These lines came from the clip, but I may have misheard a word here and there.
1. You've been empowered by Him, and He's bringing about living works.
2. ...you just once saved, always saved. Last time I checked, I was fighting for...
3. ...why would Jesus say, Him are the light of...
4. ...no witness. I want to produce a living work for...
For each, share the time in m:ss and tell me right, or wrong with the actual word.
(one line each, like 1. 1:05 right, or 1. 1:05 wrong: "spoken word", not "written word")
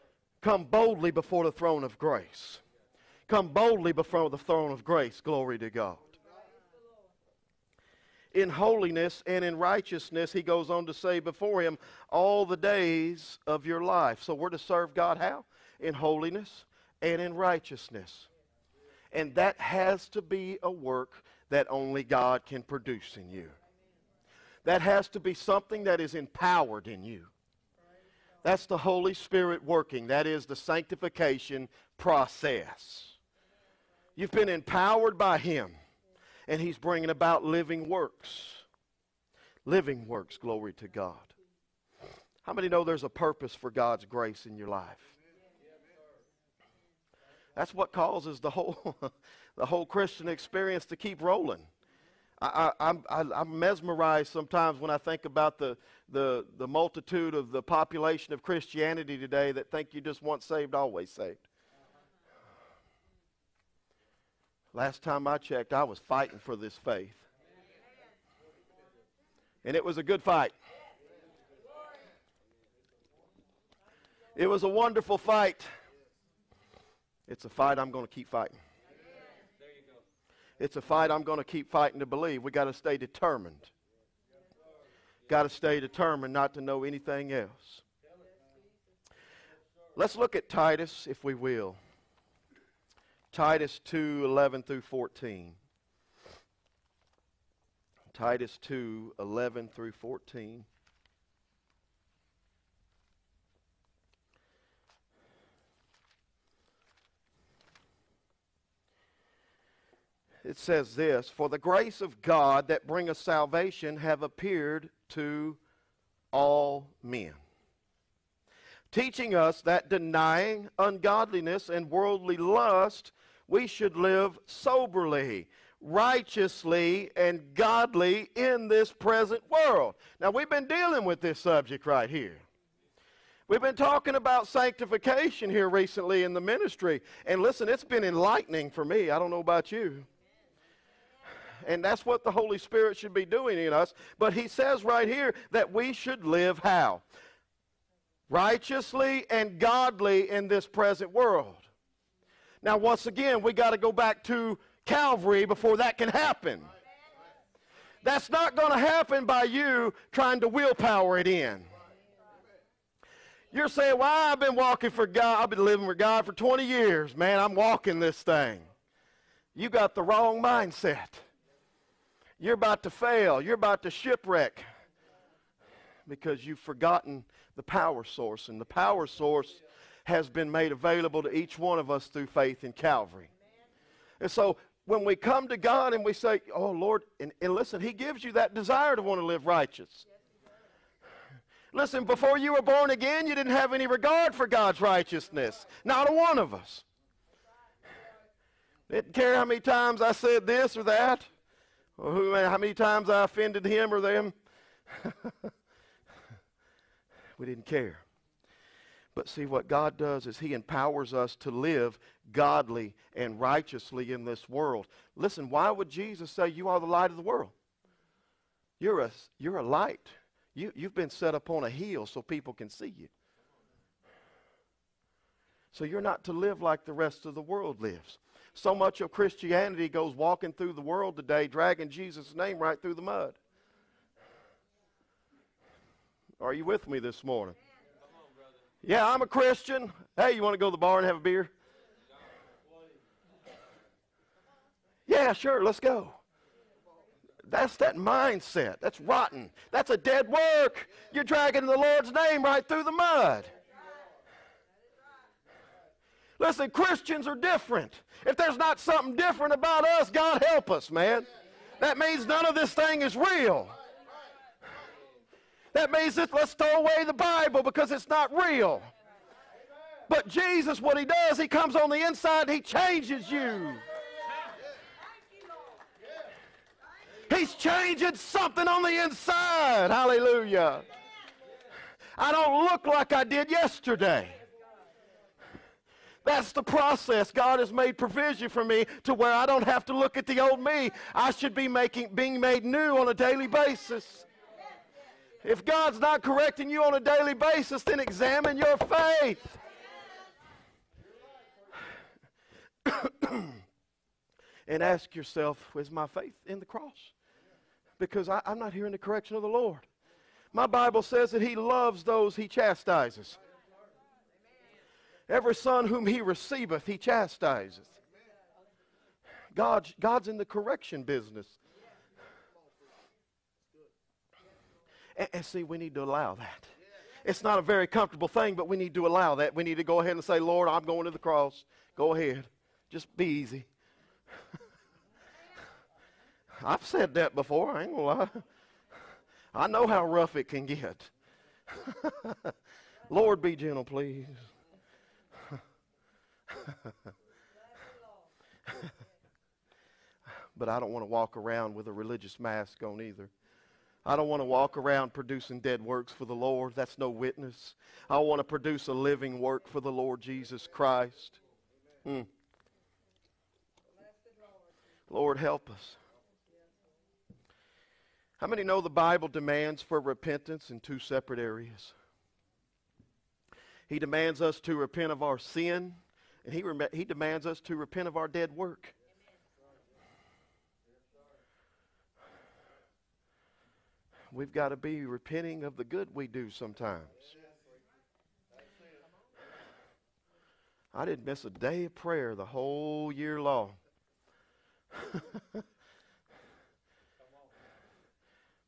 1. 0:34 right
2. 0:59 right
3. 3:35 wrong: "You", not "Him"
4. 5:56 right.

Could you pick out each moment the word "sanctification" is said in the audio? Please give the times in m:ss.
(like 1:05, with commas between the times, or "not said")
0:30, 2:14.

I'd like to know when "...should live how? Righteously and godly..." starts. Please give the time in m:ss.
2:25.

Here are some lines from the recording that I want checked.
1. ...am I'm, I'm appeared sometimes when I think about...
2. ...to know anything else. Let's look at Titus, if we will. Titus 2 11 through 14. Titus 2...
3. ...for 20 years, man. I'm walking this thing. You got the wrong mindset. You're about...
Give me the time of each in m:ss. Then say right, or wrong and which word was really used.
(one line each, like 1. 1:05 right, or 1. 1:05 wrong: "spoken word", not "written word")
1. 0:52 wrong: "mesmerized", not "appeared"
2. 1:26 right
3. 2:46 right.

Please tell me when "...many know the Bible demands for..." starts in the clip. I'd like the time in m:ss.
6:08.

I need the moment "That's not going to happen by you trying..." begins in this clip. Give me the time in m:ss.
2:38.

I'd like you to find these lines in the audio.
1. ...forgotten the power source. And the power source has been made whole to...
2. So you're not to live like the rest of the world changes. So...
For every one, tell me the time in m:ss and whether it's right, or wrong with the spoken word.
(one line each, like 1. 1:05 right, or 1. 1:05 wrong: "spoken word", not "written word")
1. 2:56 wrong: "available", not "whole"
2. 3:45 wrong: "lives", not "changes".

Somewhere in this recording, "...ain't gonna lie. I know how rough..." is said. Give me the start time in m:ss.
5:37.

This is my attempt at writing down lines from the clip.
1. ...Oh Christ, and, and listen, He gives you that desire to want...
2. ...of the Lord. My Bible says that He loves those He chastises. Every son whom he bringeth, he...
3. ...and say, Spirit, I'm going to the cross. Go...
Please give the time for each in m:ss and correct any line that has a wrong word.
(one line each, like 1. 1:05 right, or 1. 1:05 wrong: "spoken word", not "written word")
1. 3:06 wrong: "Lord", not "Christ"
2. 5:09 wrong: "receiveth", not "bringeth"
3. 5:30 wrong: "Lord", not "Spirit".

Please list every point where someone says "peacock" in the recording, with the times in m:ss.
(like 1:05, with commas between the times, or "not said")
not said.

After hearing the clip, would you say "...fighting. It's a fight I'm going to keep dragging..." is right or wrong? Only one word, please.
wrong.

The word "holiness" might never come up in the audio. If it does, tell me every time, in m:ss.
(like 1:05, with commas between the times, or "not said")
0:08, 0:15.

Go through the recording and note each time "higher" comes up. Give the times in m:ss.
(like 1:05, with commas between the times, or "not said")
not said.